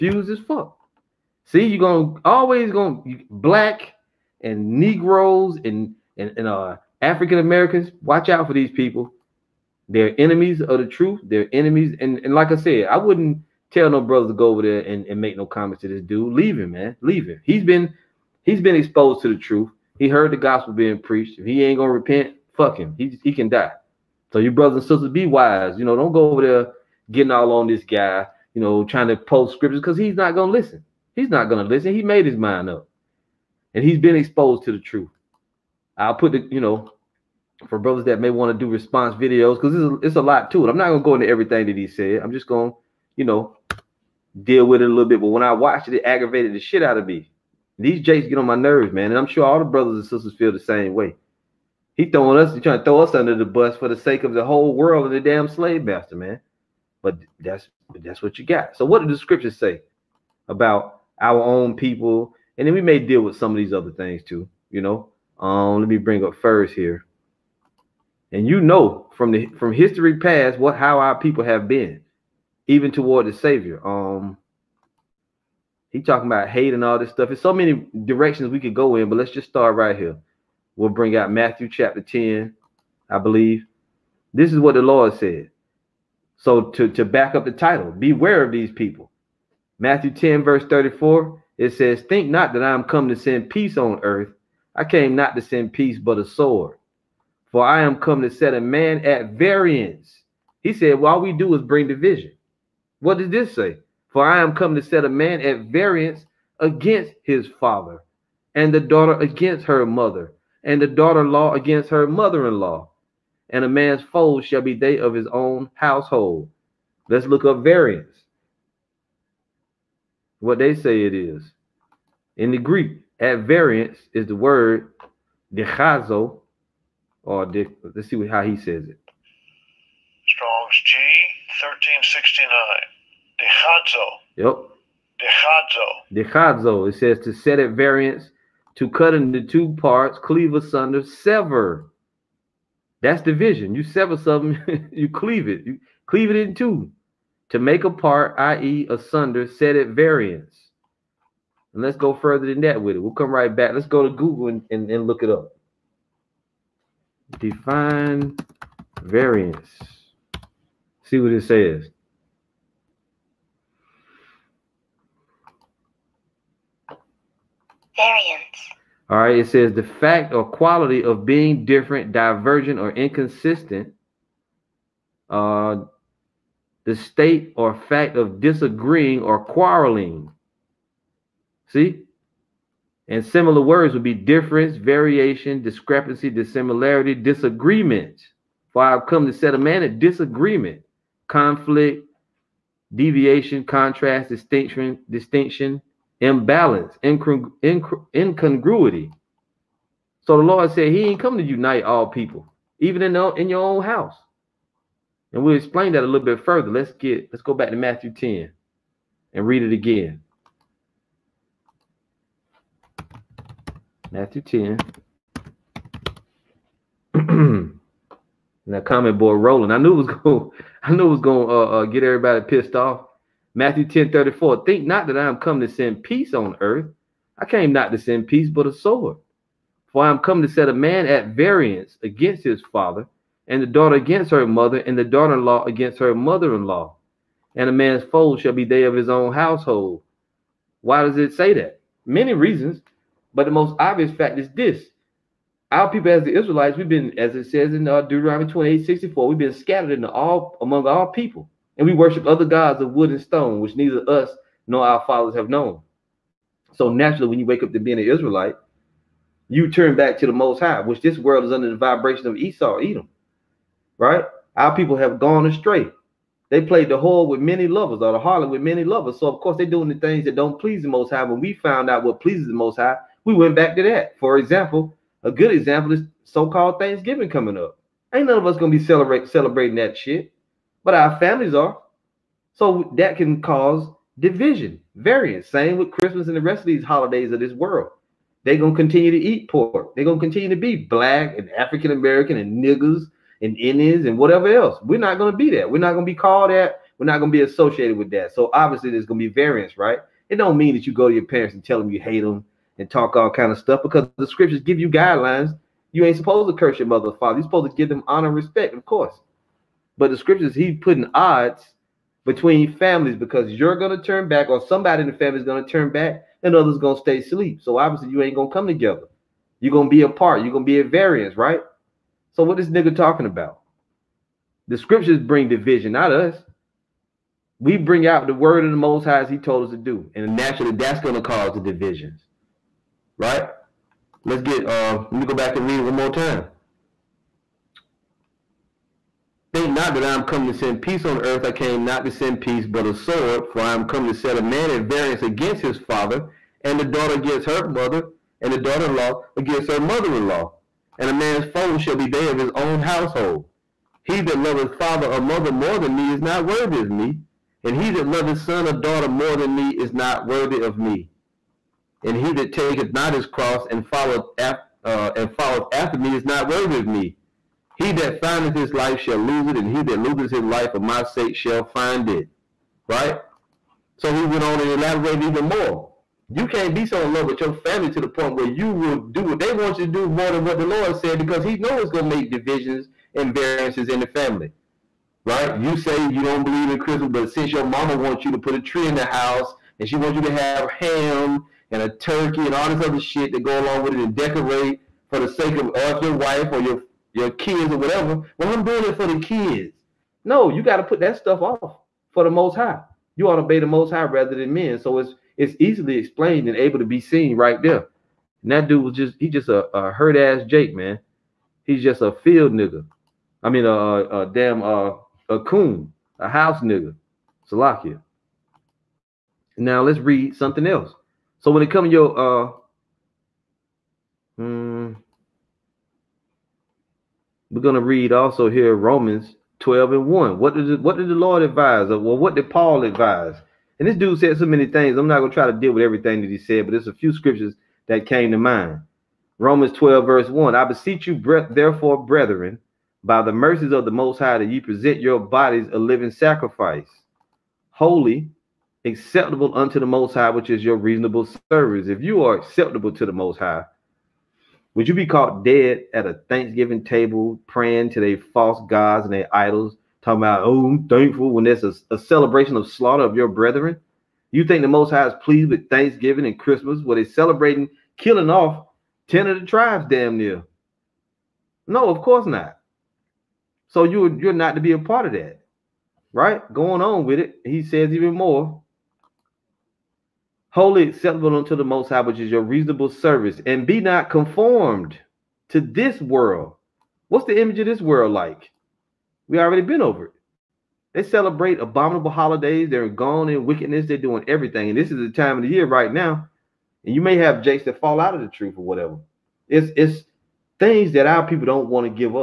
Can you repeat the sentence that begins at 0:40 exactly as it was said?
I'm not going to go into everything that he said.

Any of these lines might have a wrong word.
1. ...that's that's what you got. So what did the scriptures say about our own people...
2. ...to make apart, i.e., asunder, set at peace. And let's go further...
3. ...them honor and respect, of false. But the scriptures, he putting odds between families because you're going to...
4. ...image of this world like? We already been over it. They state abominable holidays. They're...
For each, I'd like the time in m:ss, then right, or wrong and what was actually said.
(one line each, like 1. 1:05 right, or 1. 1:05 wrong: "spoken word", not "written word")
1. 0:57 right
2. 2:27 wrong: "variance", not "peace"
3. 5:07 wrong: "course", not "false"
4. 8:07 wrong: "celebrate", not "state".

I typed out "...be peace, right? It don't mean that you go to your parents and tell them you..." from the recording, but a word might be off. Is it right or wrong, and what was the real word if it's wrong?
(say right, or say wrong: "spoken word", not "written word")
wrong: "variance", not "peace".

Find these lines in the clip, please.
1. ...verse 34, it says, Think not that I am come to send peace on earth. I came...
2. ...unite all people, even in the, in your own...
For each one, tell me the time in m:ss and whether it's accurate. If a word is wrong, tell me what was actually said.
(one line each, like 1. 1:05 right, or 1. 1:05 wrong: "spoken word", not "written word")
1. 1:30 right
2. 3:21 right.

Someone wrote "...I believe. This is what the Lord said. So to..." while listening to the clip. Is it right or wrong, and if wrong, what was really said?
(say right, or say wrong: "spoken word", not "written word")
right.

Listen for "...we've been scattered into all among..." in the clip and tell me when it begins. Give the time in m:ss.
4:09.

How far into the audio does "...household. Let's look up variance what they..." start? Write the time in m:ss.
1:55.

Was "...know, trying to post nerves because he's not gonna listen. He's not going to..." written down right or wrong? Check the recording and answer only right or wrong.
wrong.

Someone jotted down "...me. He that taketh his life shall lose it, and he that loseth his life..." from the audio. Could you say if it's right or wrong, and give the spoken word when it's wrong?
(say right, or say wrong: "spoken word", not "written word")
wrong: "findeth", not "taketh".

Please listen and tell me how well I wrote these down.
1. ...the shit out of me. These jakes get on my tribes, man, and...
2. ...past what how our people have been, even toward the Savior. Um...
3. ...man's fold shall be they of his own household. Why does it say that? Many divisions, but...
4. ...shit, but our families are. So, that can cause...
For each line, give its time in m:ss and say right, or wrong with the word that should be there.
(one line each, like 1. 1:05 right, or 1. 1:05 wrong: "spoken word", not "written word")
1. 0:46 wrong: "nerves", not "tribes"
2. 1:10 right
3. 3:57 wrong: "reasons", not "divisions"
4. 4:39 right.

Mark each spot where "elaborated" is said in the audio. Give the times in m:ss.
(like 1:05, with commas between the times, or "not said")
6:14.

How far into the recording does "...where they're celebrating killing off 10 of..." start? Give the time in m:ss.
7:46.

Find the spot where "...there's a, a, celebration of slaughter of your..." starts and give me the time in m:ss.
7:41.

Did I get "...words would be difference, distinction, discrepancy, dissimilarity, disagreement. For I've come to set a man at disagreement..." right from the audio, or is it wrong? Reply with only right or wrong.
wrong.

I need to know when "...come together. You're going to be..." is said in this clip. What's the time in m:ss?
5:18.